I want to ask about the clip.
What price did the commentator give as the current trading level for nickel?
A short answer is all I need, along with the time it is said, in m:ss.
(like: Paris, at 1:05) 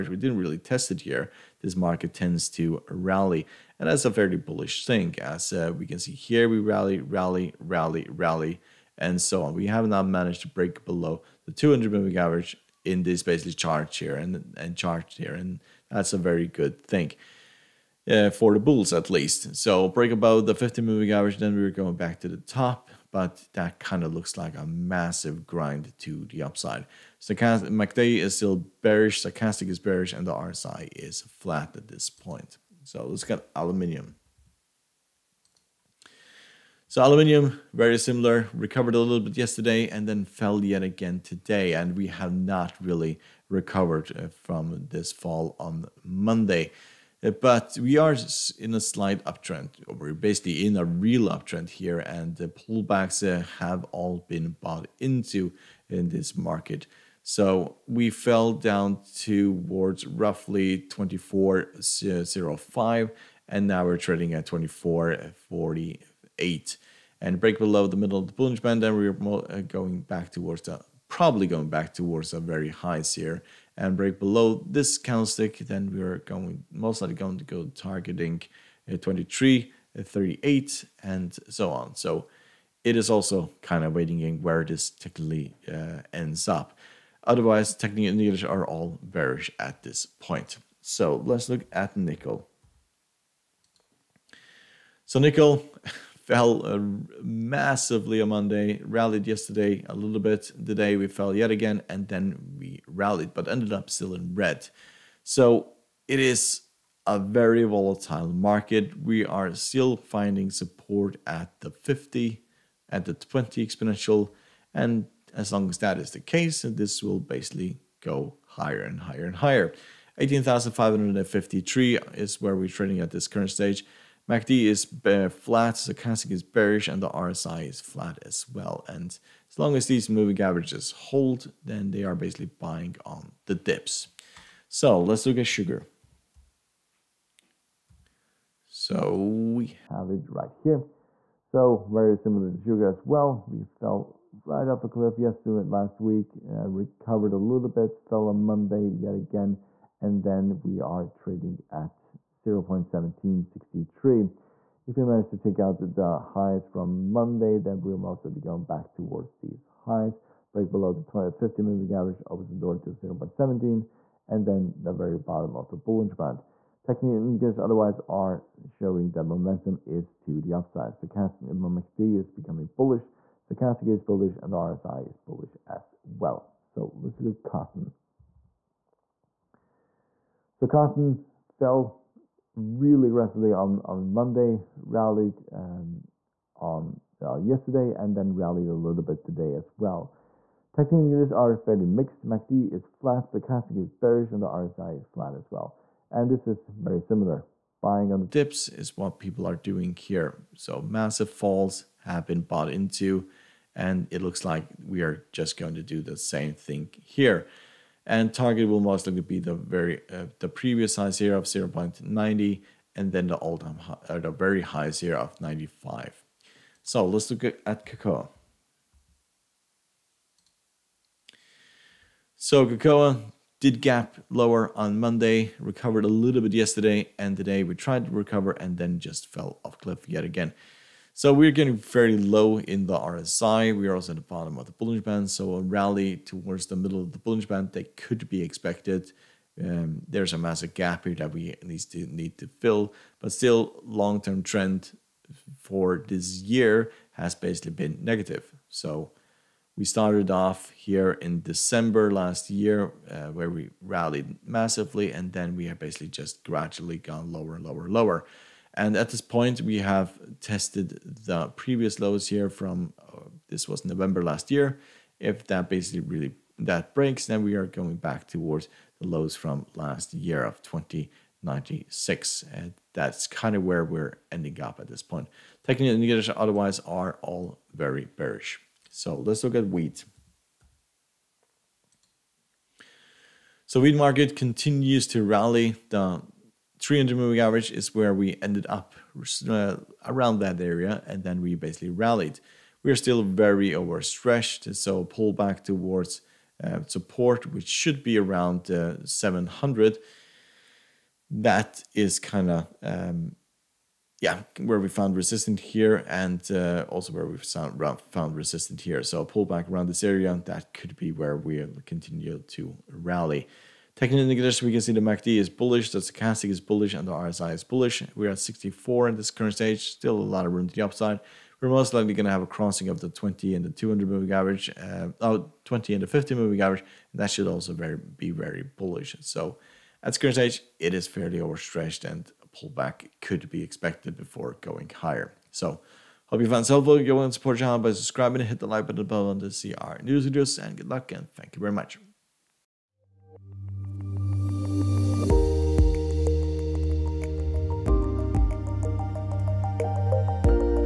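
18,553, at 2:00.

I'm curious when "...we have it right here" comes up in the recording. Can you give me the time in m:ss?
2:19.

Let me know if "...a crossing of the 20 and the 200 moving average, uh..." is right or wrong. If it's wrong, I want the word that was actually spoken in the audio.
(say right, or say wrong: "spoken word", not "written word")
right.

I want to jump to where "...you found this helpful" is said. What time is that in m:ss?
5:36.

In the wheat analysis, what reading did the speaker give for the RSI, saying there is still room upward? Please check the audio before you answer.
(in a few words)
64.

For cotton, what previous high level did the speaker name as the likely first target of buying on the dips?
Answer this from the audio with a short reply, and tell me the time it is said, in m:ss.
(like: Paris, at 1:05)
0.90, at 3:31.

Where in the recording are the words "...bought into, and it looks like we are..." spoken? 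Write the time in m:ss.
3:22.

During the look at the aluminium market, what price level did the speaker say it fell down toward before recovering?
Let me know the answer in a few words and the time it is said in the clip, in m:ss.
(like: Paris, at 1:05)
24.05, at 1:00.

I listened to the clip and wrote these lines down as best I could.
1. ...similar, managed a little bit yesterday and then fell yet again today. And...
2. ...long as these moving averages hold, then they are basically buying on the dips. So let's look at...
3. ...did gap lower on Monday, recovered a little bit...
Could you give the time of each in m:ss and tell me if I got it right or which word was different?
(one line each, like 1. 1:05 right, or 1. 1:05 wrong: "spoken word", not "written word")
1. 0:37 wrong: "recovered", not "managed"
2. 2:09 right
3. 3:43 right.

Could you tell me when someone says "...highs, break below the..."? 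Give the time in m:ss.
2:39.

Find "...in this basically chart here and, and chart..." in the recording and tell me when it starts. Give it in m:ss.
0:12.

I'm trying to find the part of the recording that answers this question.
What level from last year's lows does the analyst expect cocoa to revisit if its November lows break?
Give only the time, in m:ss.
4:30.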